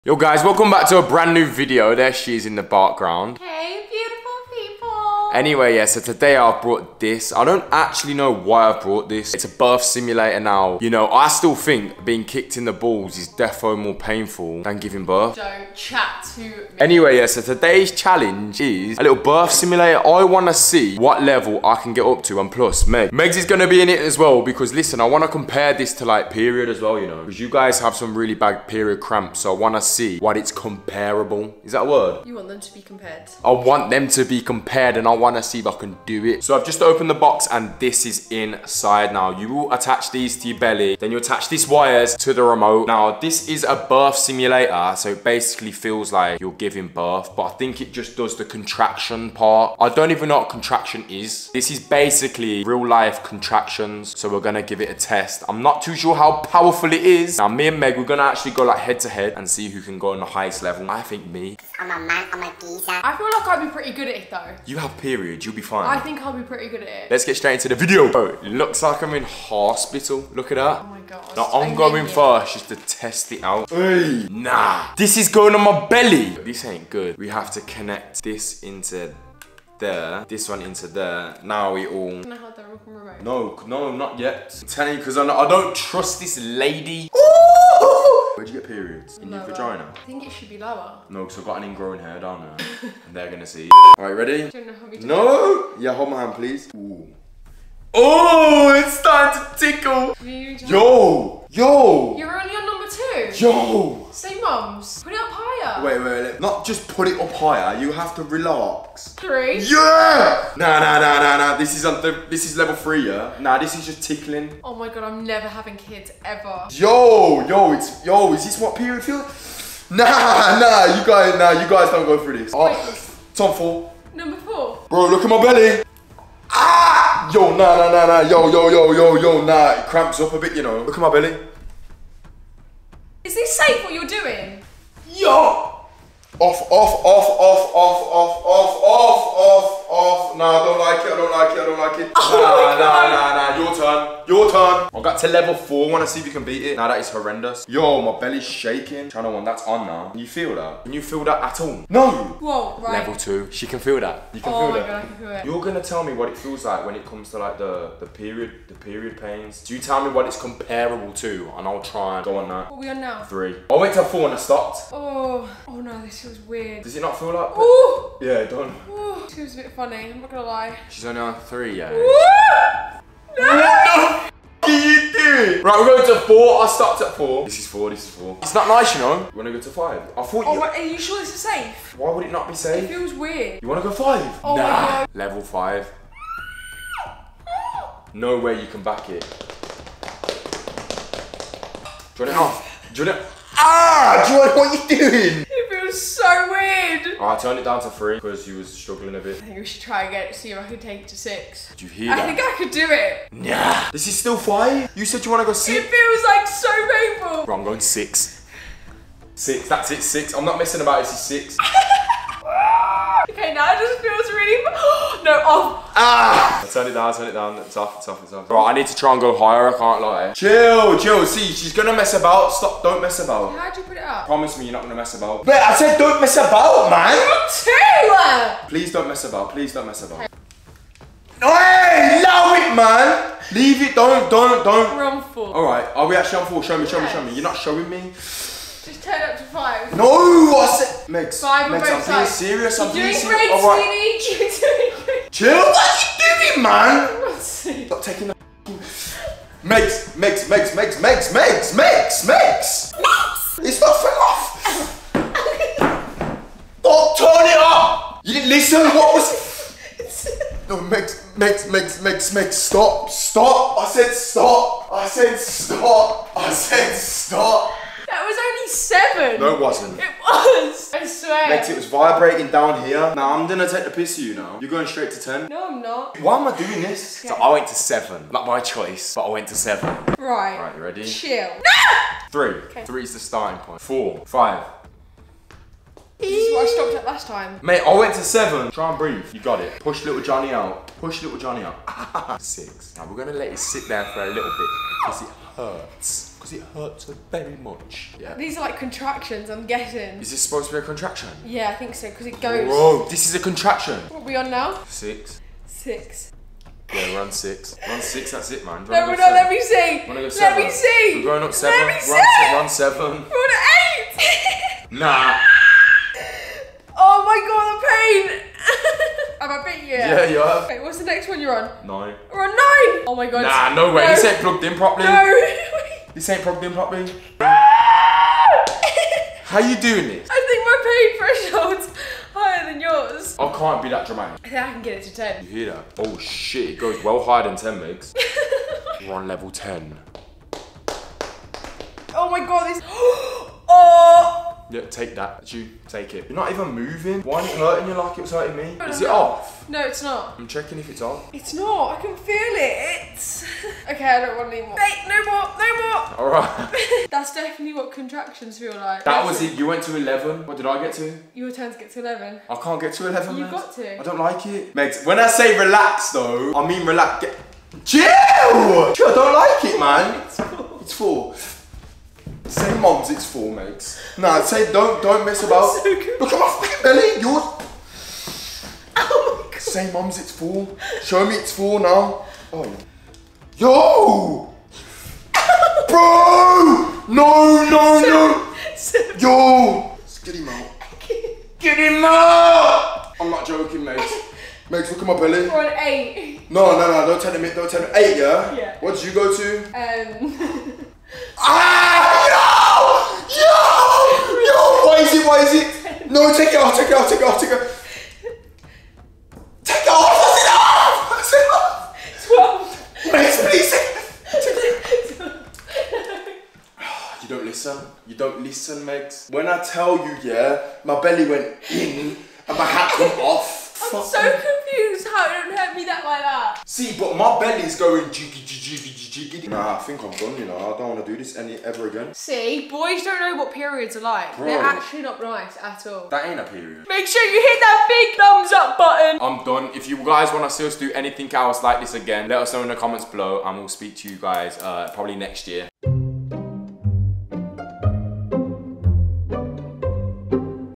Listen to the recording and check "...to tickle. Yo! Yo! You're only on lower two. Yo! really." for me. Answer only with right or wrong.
wrong.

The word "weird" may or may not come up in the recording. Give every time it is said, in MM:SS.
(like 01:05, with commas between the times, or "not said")
02:46, 03:03, 03:16.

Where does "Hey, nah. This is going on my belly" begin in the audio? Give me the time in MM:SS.
01:13.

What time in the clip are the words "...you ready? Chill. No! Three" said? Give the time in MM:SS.
04:40.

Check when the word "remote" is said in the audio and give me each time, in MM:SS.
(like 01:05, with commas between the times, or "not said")
00:42, 01:22.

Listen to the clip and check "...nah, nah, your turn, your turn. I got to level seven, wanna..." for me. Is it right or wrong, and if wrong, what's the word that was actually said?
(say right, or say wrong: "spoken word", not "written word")
wrong: "four", not "seven".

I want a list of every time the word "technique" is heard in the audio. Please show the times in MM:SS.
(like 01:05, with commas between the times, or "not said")
not said.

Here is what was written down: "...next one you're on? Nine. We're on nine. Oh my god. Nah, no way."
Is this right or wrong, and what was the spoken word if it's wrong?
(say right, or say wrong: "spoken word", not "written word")
right.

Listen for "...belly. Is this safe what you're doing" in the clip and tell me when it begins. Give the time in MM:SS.
02:11.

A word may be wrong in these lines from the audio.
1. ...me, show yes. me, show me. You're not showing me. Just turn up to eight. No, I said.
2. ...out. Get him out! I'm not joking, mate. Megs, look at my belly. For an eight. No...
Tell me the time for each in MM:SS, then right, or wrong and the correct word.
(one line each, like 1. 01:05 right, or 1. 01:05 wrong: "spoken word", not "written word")
1. 03:56 wrong: "five", not "eight"
2. 06:30 right.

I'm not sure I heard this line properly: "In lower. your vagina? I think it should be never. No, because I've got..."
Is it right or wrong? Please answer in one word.
wrong.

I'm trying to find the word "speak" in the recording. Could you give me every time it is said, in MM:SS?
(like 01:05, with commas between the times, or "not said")
07:23.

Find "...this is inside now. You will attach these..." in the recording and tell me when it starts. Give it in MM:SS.
00:37.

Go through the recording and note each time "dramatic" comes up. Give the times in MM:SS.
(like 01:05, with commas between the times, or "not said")
05:34.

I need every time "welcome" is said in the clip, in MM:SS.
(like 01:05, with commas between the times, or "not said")
00:00.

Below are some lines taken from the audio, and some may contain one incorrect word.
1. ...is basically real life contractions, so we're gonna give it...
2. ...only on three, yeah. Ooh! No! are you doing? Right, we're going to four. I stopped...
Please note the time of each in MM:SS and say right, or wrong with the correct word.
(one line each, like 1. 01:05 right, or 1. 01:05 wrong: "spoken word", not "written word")
1. 00:51 right
2. 02:51 right.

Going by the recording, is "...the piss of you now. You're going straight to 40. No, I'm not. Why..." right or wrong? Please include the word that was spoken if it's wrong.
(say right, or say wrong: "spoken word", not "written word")
wrong: "10", not "40".